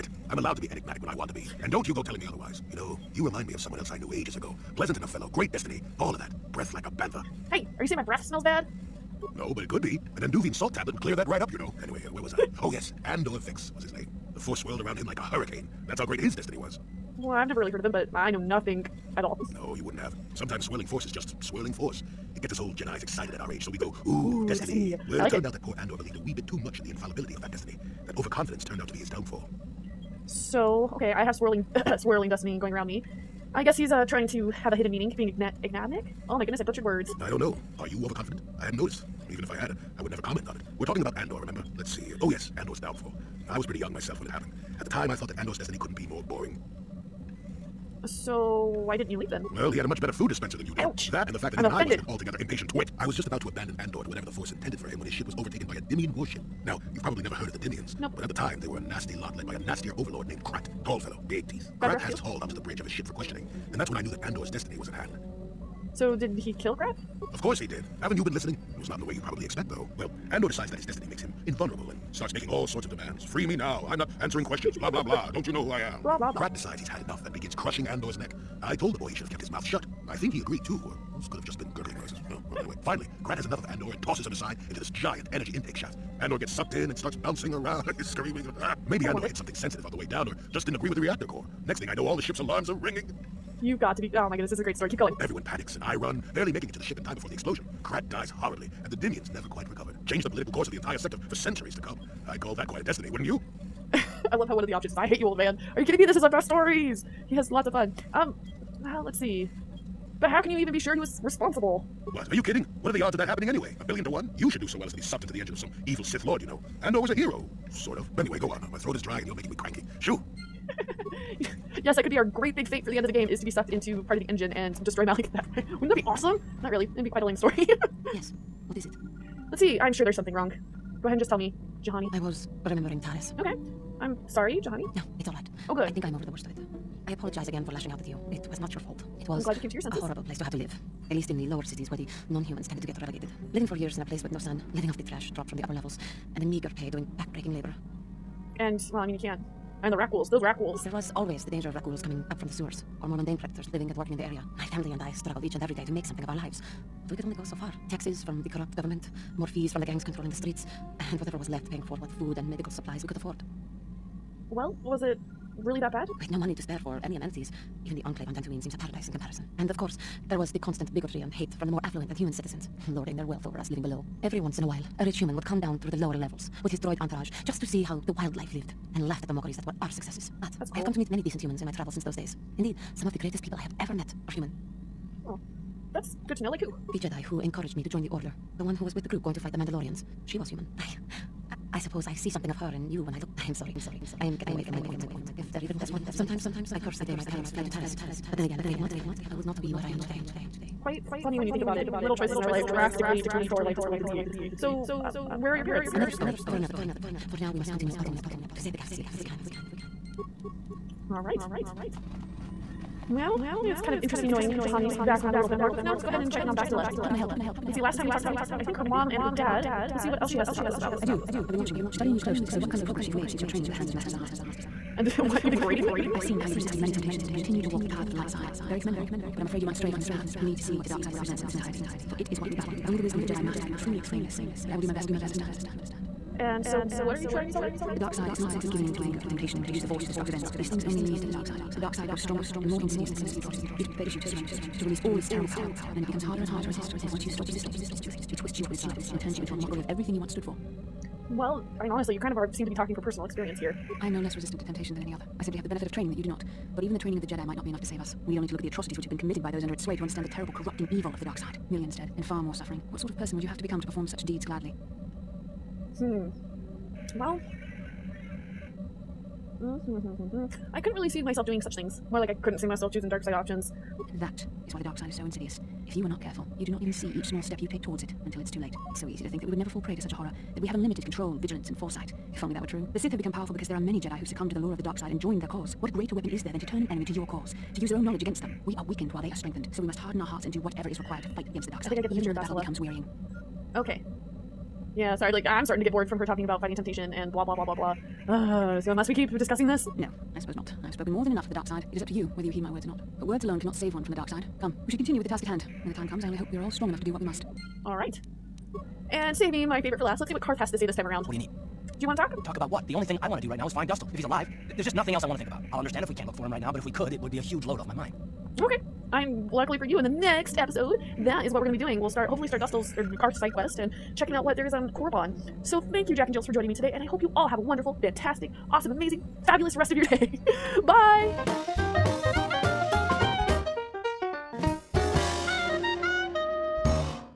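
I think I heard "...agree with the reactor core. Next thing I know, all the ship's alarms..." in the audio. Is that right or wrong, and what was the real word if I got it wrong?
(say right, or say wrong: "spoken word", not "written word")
right.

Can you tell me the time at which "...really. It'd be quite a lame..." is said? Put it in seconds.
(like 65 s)
126 s.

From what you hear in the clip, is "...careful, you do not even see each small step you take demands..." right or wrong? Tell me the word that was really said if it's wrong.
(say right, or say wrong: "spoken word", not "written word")
wrong: "towards", not "demands".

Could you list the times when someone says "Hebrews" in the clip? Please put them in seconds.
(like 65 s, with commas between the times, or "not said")
not said.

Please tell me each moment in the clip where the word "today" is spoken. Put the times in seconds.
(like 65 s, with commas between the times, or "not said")
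199 s, 326 s.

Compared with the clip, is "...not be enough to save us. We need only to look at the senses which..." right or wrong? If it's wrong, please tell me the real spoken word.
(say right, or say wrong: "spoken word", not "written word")
wrong: "atrocities", not "senses".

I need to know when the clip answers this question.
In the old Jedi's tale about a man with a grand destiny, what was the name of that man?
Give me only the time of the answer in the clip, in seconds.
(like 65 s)
13 s.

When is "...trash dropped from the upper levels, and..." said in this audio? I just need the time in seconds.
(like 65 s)
145 s.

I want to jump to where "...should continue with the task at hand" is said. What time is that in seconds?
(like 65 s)
304 s.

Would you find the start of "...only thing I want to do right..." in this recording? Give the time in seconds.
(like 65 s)
312 s.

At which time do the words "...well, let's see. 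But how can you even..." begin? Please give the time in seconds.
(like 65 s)
108 s.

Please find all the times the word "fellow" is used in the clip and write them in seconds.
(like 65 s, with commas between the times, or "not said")
5 s, 60 s.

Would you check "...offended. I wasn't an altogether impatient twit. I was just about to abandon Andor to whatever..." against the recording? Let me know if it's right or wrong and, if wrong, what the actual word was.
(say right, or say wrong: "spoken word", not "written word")
right.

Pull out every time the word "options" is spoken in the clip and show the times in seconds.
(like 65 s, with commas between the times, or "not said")
104 s, 273 s.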